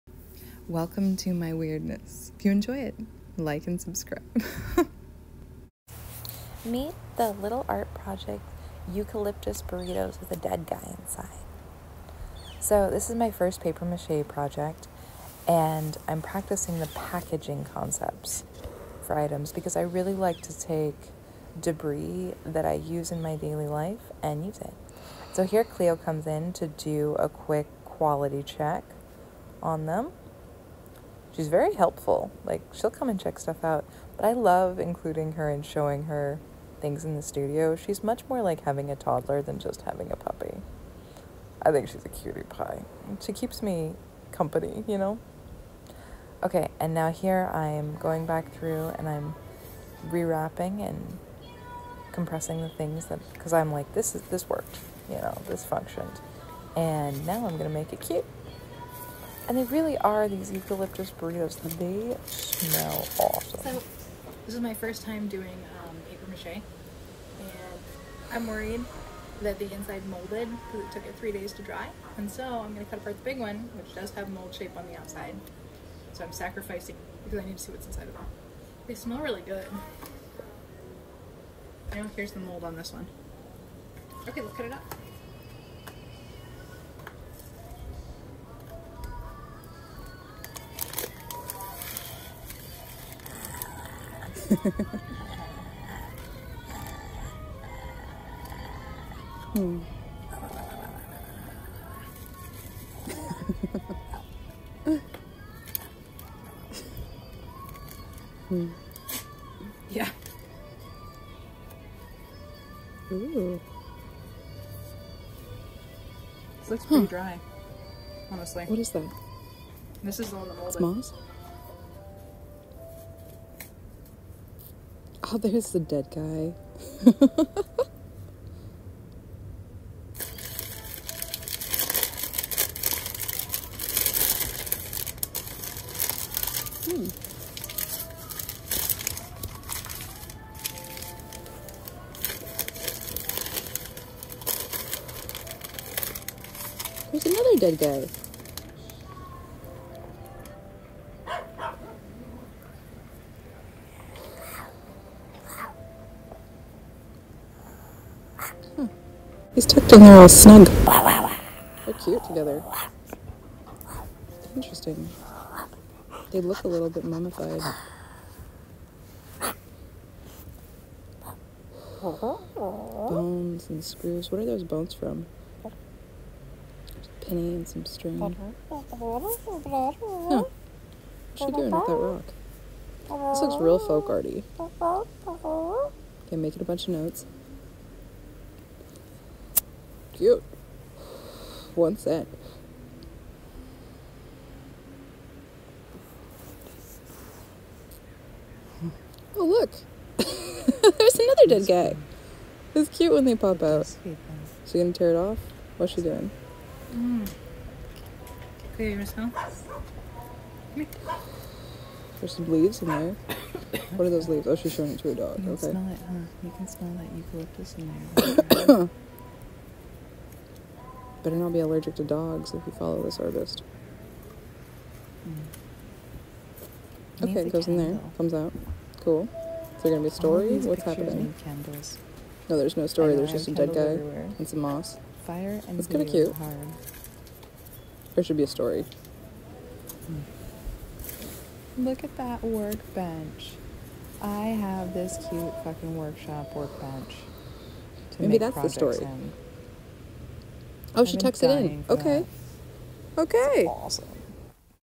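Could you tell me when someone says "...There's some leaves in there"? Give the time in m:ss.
3:28.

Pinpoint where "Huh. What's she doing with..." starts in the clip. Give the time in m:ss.
2:58.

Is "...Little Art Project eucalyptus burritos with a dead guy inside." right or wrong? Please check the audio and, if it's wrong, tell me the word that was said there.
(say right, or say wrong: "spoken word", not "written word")
right.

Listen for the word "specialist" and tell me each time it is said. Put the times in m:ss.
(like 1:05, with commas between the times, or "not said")
not said.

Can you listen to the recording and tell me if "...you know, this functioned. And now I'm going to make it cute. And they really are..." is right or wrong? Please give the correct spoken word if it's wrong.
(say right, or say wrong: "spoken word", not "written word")
right.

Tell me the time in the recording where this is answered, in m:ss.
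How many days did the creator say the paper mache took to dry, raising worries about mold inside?
1:11.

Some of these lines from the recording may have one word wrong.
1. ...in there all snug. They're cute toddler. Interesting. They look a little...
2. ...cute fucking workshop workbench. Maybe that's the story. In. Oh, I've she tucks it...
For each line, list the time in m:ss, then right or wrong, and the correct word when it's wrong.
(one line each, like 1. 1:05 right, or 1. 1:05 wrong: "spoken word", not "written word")
1. 2:39 wrong: "together", not "toddler"
2. 4:05 right.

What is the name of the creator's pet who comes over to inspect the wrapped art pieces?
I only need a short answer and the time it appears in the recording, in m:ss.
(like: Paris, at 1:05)
Cleo, at 0:25.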